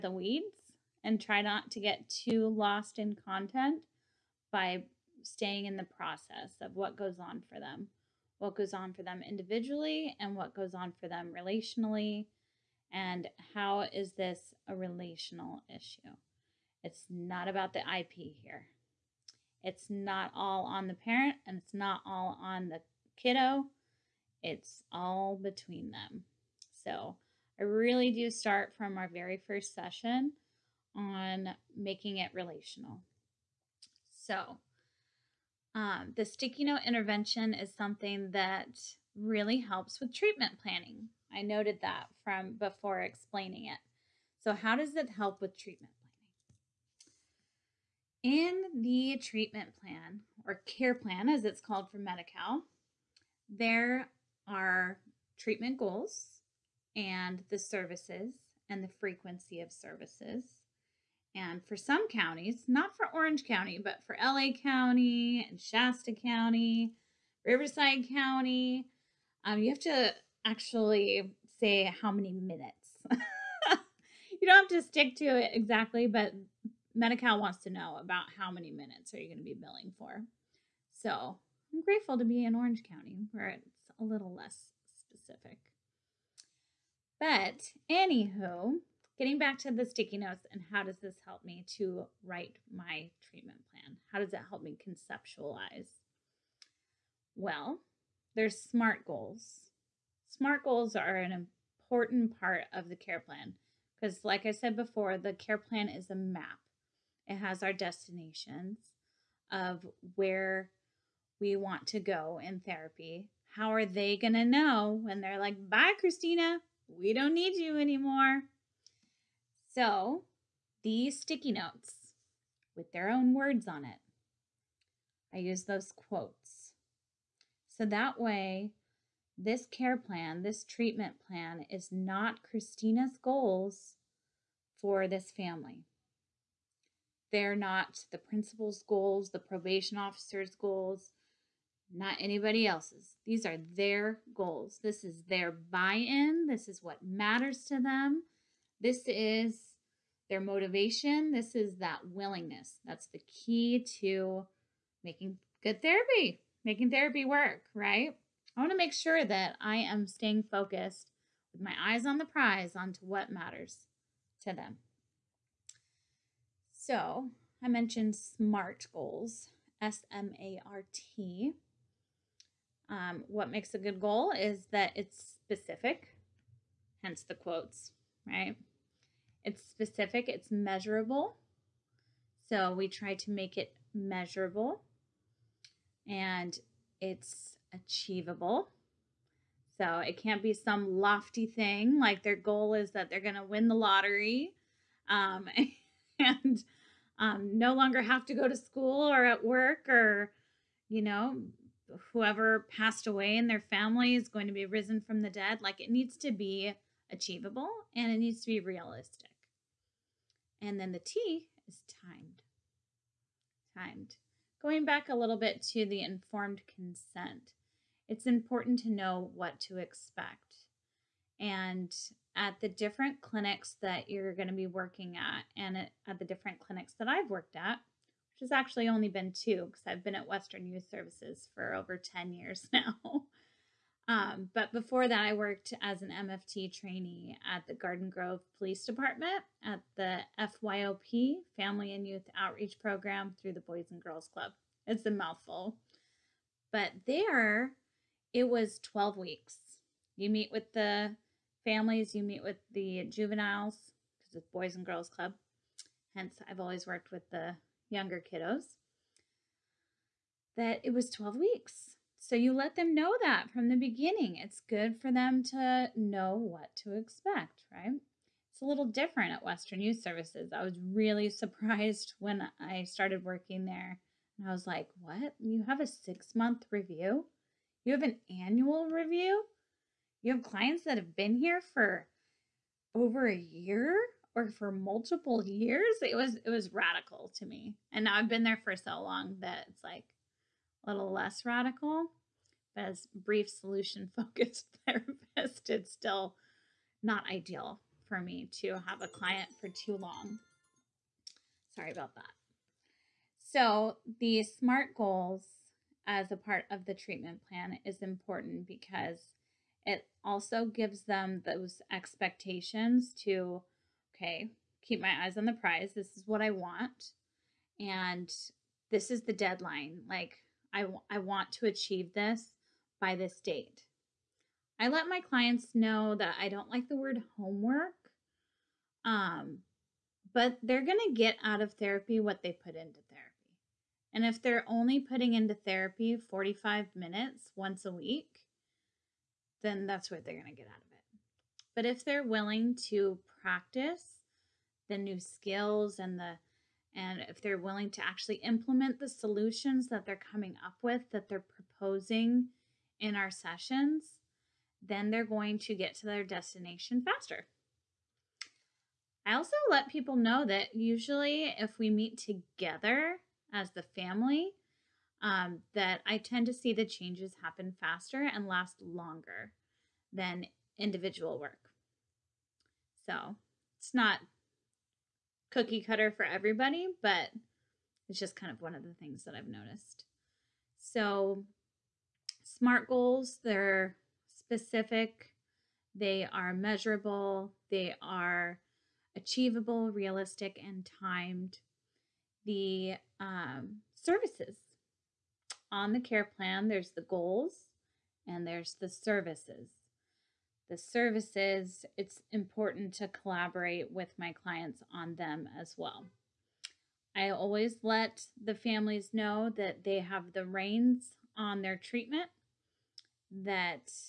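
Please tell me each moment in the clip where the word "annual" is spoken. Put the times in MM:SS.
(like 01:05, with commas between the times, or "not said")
04:38.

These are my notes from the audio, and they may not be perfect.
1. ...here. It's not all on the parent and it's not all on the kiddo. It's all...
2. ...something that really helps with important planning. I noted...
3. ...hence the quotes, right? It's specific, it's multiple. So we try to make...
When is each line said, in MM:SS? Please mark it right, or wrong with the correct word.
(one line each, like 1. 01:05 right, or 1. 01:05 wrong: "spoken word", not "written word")
1. 00:18 right
2. 00:37 wrong: "treatment", not "important"
3. 02:57 wrong: "measurable", not "multiple".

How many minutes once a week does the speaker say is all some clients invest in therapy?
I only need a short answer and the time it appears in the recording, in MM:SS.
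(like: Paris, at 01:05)
45, at 05:36.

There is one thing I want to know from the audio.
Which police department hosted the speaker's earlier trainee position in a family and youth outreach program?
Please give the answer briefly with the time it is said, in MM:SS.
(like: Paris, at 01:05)
Garden Grove, at 03:57.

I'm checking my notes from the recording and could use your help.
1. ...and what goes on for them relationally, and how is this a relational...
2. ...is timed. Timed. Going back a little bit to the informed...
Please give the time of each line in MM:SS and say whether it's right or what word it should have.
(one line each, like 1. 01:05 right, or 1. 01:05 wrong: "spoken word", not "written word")
1. 00:10 right
2. 03:31 right.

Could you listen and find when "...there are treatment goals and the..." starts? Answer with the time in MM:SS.
00:53.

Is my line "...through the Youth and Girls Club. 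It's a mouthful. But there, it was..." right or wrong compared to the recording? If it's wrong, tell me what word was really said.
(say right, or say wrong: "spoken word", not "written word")
wrong: "Boys", not "Youth".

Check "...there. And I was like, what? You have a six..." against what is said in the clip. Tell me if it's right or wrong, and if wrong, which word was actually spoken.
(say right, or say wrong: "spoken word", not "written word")
right.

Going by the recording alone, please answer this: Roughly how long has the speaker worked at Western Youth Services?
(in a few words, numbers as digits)
Over 10 years.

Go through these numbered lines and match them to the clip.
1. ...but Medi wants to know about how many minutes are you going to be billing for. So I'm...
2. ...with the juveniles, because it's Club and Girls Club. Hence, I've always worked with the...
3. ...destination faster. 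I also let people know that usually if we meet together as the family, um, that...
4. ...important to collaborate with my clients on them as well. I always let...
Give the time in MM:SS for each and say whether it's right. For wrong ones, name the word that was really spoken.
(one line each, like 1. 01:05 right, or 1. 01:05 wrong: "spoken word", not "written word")
1. 01:16 right
2. 04:12 wrong: "Boys", not "Club"
3. 05:56 right
4. 06:42 right.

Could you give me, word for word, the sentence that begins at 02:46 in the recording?
So I mentioned SMART goals, S M A R T.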